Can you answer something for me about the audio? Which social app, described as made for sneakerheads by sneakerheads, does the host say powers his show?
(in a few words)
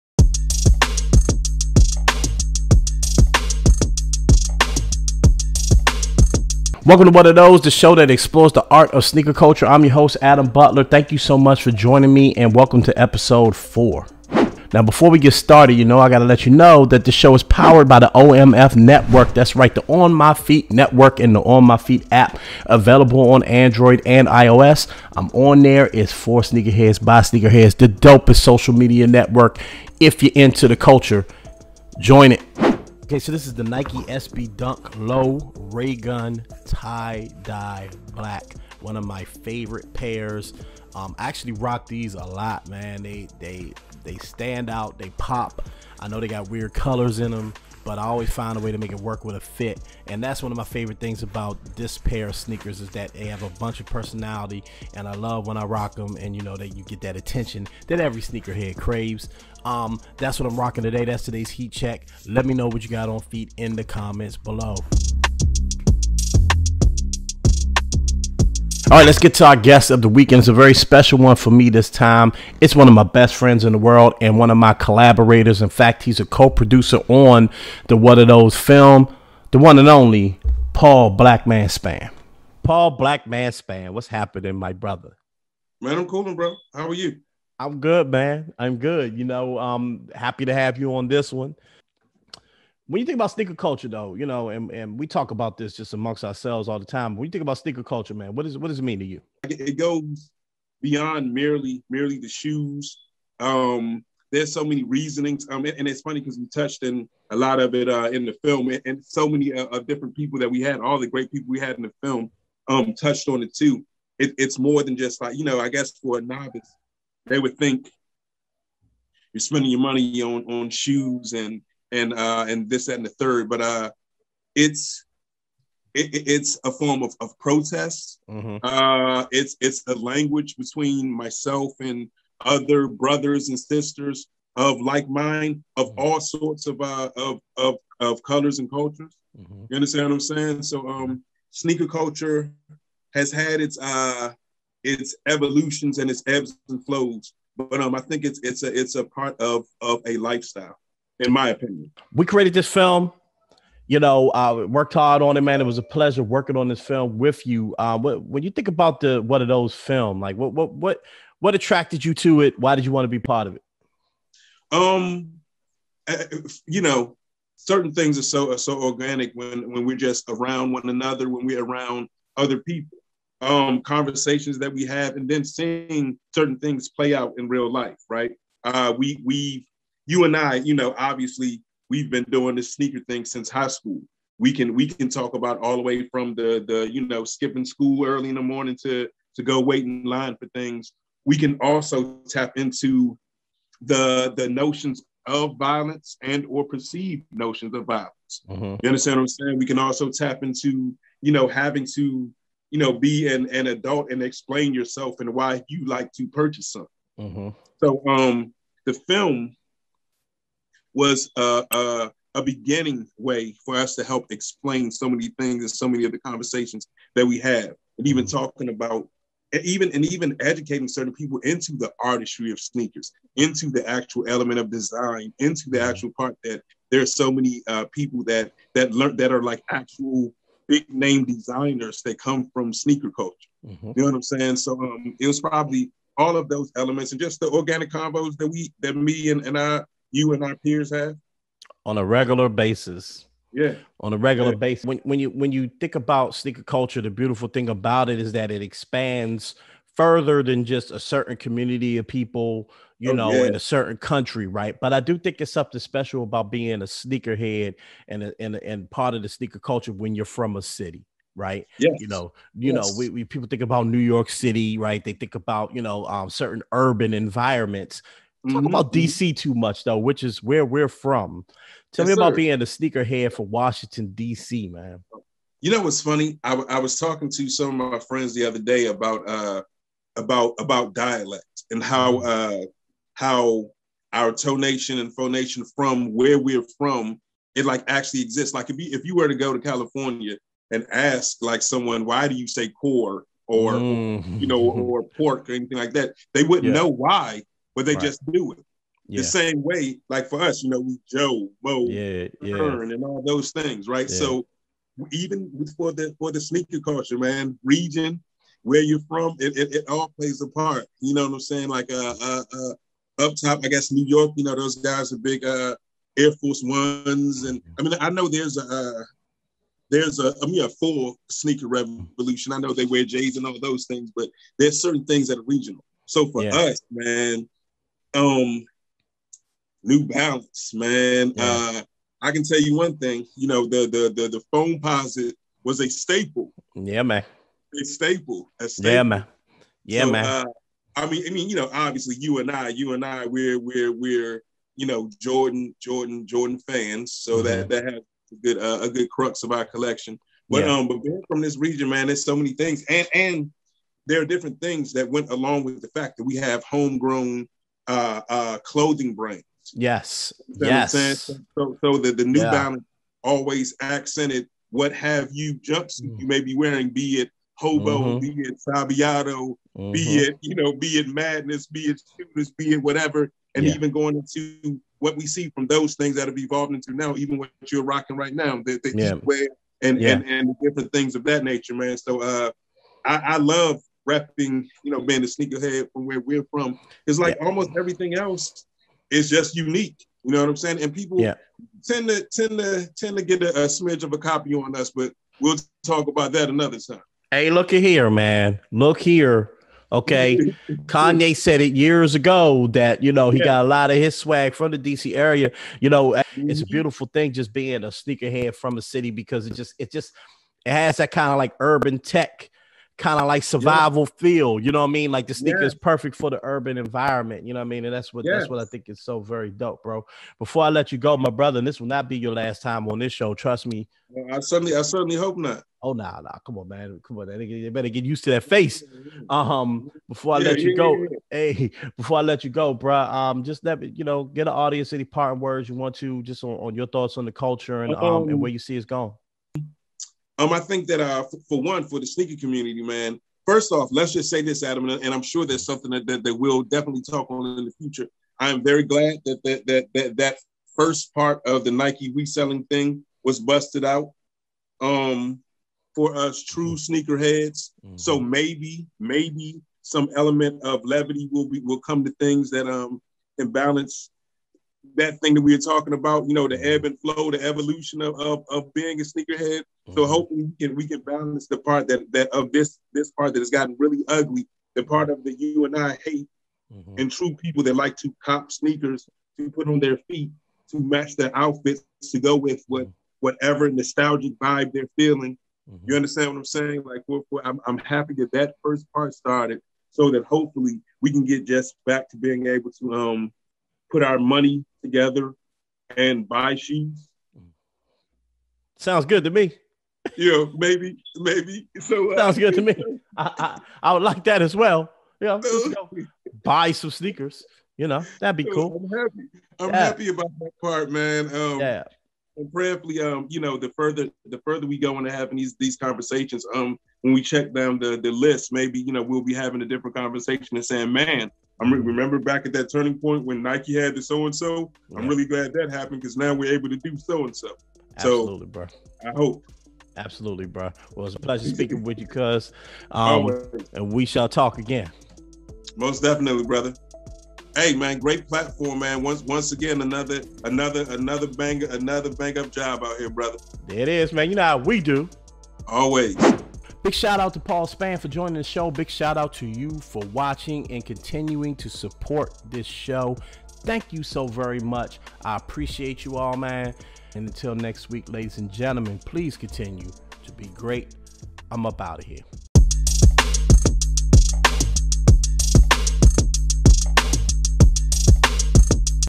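On My Feet app.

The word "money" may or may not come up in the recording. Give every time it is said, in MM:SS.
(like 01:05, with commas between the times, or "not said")
01:59, 08:14.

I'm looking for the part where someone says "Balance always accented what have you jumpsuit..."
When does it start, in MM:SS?
06:02.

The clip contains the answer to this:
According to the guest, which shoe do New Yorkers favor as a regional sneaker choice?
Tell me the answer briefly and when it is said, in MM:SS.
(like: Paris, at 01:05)
Air Force Ones, at 05:16.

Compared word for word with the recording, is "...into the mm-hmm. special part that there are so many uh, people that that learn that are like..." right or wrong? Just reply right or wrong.
wrong.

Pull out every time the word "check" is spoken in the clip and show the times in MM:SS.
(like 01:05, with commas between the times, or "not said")
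01:01, 08:37.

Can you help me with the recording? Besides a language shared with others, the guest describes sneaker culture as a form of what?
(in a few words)
Protest.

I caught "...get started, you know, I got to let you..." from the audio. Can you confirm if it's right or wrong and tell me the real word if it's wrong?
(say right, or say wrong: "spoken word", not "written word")
right.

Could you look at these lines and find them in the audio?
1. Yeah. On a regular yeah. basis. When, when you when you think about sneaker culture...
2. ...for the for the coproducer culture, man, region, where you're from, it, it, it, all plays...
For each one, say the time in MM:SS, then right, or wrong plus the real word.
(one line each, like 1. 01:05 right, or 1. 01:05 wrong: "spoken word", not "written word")
1. 04:03 right
2. 05:05 wrong: "sneaker", not "coproducer".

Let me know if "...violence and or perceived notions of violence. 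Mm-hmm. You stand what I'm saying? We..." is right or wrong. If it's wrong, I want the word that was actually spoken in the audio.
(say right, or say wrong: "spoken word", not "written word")
wrong: "understand", not "stand".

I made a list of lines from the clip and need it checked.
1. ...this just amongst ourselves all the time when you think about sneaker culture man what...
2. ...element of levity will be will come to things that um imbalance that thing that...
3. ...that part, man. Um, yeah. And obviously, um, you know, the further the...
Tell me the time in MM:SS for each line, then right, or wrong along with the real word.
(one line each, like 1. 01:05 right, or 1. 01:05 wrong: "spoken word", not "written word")
1. 01:35 right
2. 07:40 right
3. 08:30 wrong: "prayerfully", not "obviously".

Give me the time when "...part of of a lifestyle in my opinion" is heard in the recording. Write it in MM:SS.
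02:29.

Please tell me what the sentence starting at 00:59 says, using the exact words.
Um, that's what I'm rocking today.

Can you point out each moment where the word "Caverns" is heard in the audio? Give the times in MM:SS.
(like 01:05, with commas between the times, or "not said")
not said.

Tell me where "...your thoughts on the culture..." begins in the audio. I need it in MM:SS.
07:16.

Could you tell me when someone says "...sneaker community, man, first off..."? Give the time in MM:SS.
07:22.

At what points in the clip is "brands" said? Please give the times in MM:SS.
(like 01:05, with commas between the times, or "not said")
05:59.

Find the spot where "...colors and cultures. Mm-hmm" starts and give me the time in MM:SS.
02:18.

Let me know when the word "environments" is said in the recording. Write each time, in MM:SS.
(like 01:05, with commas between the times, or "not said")
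04:27, 06:56.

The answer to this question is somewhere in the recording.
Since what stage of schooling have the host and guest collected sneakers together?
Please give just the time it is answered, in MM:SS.
03:03.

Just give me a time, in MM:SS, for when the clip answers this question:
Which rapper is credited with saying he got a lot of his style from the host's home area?
06:40.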